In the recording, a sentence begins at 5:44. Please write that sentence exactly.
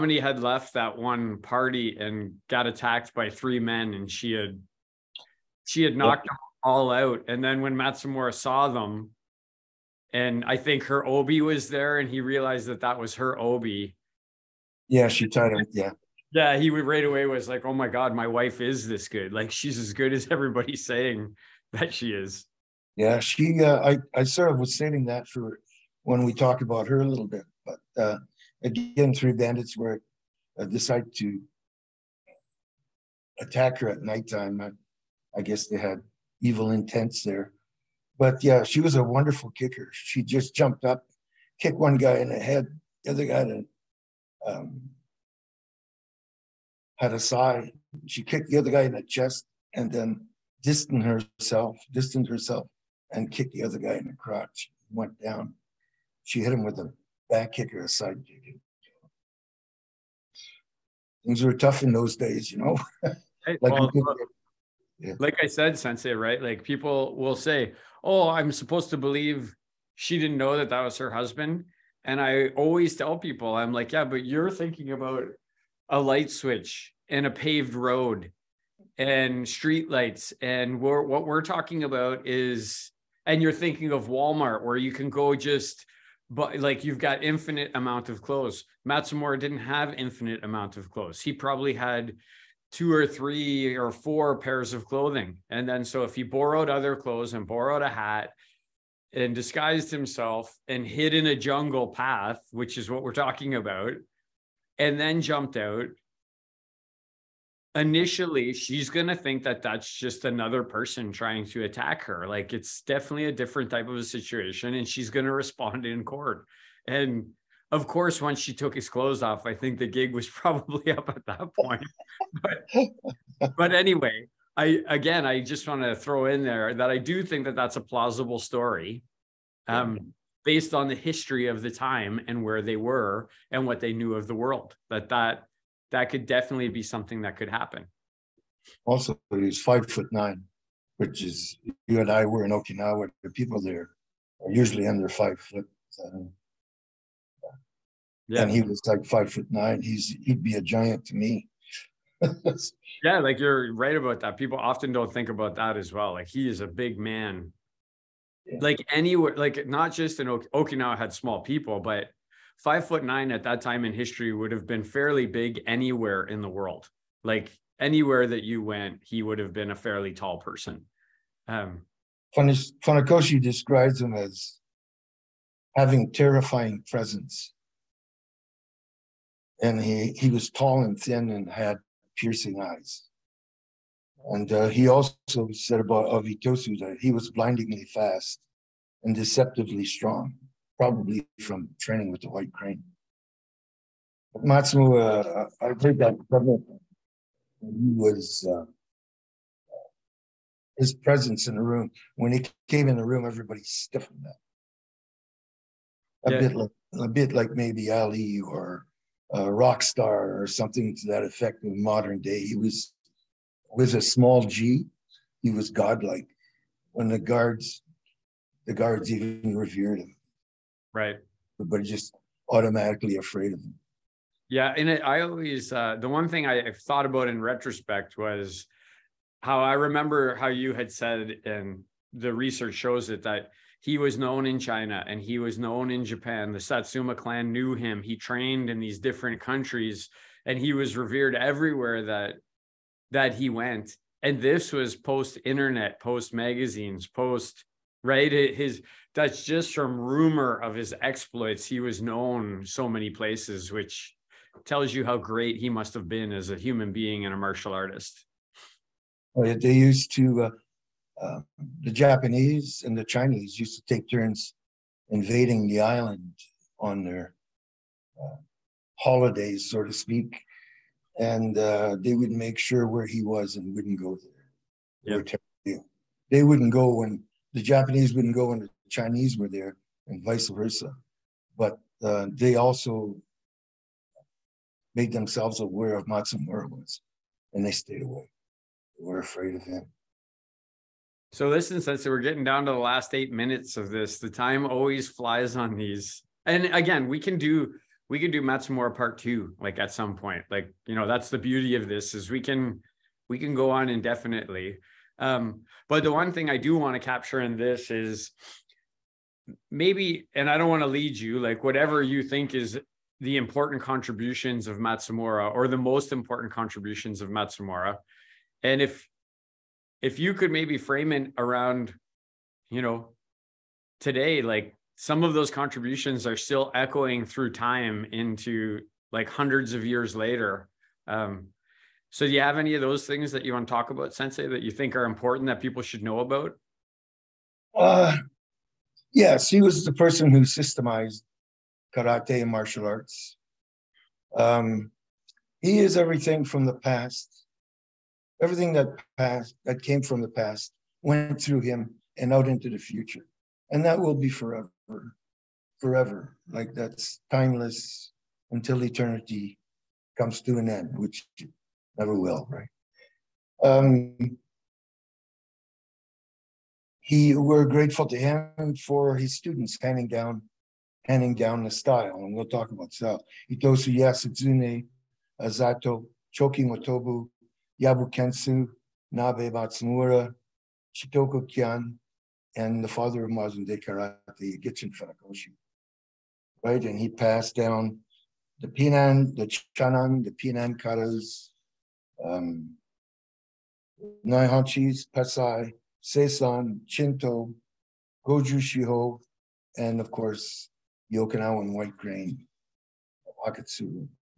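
Um, he is everything from the past.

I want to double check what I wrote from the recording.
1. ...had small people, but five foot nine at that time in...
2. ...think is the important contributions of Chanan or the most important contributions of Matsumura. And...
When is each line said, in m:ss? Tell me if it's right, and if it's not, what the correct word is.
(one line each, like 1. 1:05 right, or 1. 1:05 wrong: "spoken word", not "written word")
1. 2:40 right
2. 5:12 wrong: "Matsumura", not "Chanan".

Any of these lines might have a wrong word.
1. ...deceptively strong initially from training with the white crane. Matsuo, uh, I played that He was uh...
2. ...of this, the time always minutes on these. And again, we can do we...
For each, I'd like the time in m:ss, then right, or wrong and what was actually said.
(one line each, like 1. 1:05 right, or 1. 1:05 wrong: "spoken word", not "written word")
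1. 3:09 wrong: "probably", not "initially"
2. 4:53 wrong: "flies", not "minutes".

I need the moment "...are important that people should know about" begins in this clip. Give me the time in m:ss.
5:34.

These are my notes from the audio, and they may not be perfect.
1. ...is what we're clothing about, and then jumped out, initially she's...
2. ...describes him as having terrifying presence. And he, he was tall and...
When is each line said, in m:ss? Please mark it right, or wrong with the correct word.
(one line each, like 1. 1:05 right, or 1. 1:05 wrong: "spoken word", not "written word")
1. 1:42 wrong: "talking", not "clothing"
2. 2:53 right.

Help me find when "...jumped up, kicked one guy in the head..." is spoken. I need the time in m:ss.
0:40.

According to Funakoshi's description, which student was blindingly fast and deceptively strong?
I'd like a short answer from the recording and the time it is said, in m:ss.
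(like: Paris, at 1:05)
Itosu, at 3:06.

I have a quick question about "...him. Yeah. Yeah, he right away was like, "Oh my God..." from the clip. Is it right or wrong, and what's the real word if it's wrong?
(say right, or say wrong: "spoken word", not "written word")
right.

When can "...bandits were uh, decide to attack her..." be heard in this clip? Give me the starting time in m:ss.
0:29.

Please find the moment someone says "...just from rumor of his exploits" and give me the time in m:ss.
4:09.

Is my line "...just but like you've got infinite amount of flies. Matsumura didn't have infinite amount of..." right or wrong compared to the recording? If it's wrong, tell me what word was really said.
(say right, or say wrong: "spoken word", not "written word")
wrong: "clothes", not "flies".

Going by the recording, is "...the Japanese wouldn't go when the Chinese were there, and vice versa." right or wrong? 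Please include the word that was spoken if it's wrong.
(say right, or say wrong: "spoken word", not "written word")
right.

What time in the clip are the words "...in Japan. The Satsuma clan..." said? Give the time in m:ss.
3:55.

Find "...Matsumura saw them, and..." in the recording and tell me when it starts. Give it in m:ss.
0:07.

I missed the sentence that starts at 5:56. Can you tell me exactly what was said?
Like that's timeless until eternity comes to an end, which never will, right?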